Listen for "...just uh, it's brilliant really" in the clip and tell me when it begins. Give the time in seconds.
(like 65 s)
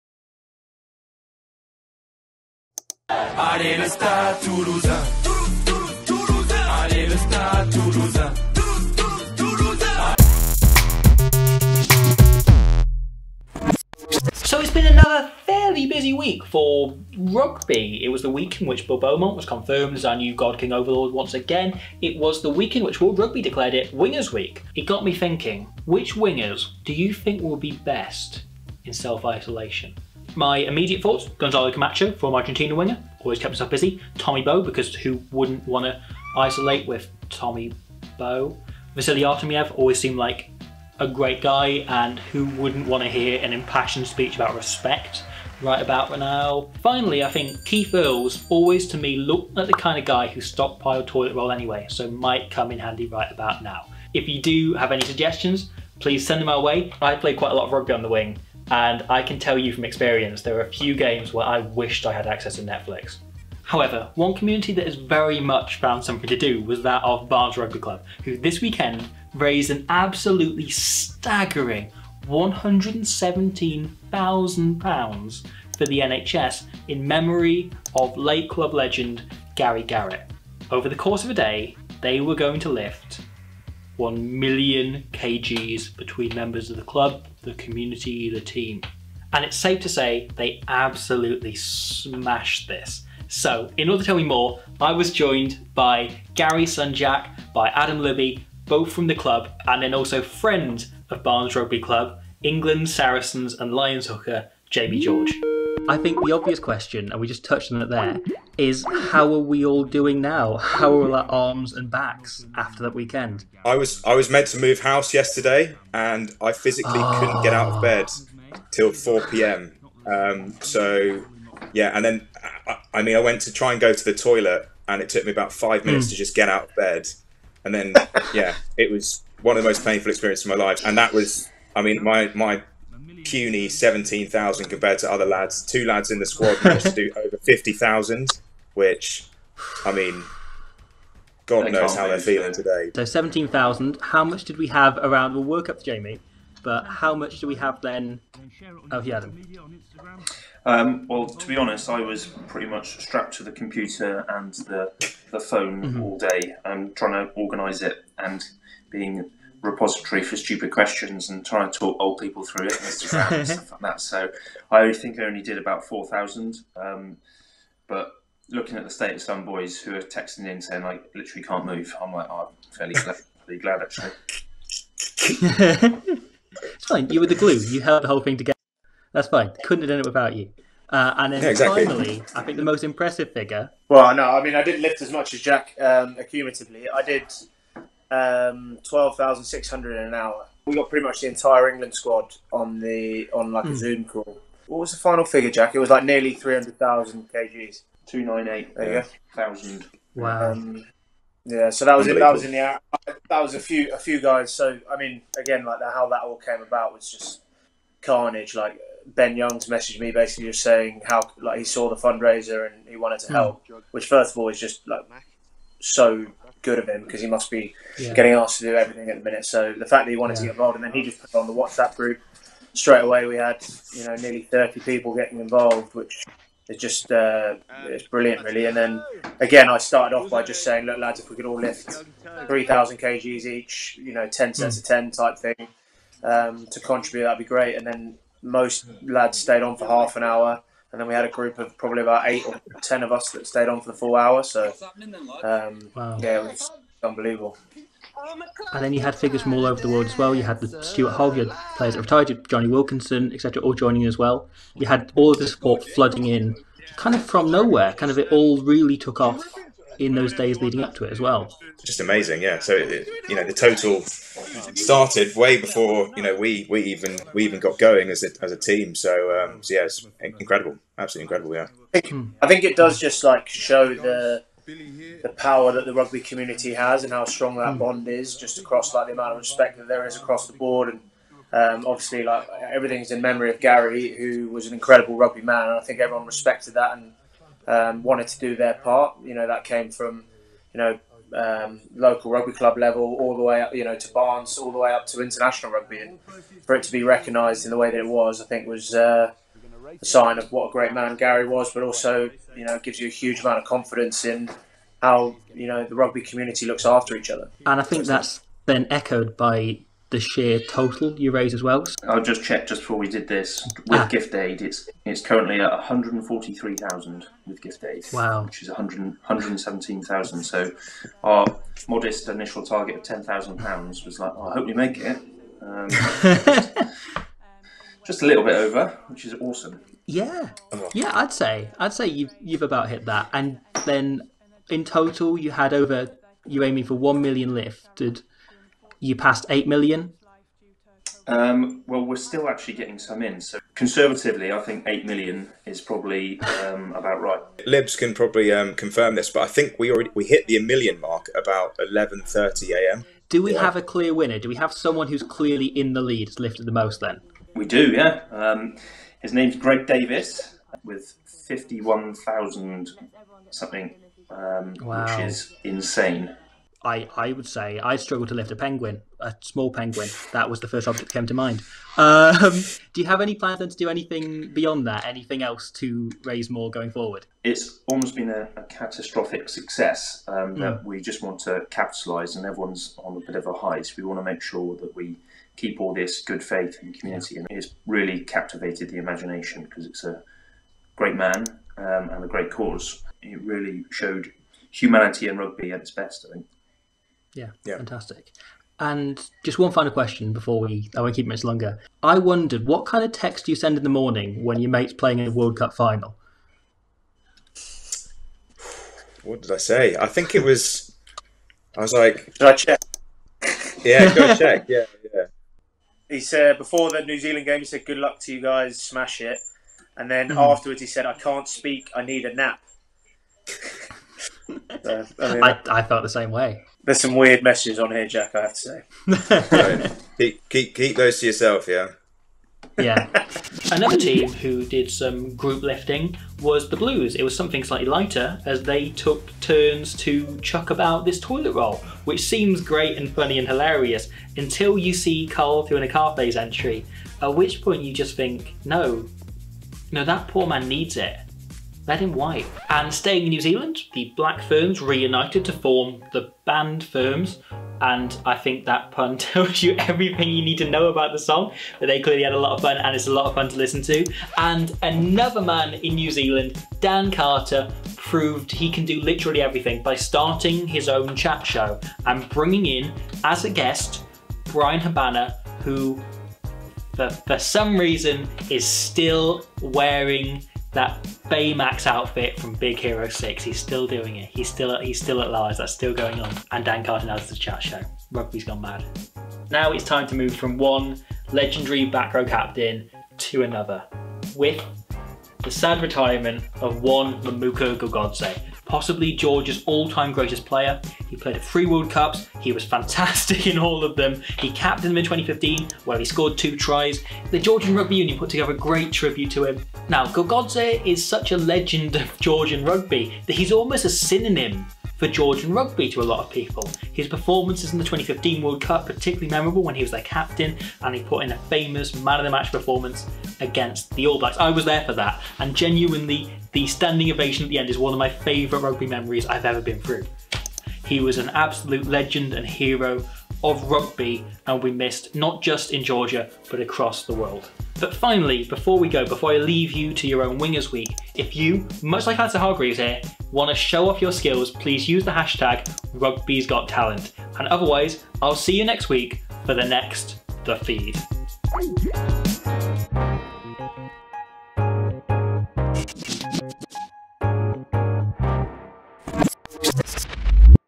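226 s.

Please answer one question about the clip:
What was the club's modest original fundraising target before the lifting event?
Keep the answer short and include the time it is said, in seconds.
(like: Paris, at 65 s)
£10,000, at 323 s.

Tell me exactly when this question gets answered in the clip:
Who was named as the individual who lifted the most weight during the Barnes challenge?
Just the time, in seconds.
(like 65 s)
359 s.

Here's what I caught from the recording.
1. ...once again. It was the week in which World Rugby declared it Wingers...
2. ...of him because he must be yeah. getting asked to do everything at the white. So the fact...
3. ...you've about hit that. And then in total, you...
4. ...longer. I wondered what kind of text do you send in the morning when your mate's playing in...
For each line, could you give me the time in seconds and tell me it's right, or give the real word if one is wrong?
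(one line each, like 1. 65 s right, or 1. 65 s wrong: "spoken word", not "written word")
1. 21 s right
2. 216 s wrong: "minute", not "white"
3. 332 s right
4. 401 s right.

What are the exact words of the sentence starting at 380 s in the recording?
that we just want to capitalise, and everyone's on a bit of a high.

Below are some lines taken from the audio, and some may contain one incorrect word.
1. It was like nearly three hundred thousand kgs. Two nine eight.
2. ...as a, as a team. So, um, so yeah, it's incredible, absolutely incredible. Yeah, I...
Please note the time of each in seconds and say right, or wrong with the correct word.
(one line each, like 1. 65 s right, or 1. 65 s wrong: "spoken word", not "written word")
1. 195 s right
2. 268 s right.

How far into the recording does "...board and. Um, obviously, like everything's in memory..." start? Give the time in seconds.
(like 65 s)
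280 s.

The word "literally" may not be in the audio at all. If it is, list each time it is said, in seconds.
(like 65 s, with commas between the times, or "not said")
171 s, 469 s.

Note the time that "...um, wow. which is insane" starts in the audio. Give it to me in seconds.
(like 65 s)
364 s.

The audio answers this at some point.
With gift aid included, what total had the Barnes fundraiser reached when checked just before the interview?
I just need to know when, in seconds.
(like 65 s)
315 s.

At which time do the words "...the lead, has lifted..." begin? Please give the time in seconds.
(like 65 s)
355 s.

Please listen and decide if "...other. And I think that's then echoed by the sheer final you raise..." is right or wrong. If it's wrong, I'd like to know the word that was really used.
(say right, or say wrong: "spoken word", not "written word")
wrong: "total", not "final".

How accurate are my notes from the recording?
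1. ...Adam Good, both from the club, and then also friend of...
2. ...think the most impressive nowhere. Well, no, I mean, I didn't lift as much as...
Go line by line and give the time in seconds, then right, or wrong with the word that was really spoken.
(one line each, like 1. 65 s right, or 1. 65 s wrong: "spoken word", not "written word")
1. 97 s wrong: "Libby", not "Good"
2. 182 s wrong: "figure", not "nowhere".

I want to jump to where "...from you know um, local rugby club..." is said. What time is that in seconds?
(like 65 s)
289 s.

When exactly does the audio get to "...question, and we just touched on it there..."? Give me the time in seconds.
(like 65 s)
106 s.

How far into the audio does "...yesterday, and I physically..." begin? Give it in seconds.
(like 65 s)
115 s.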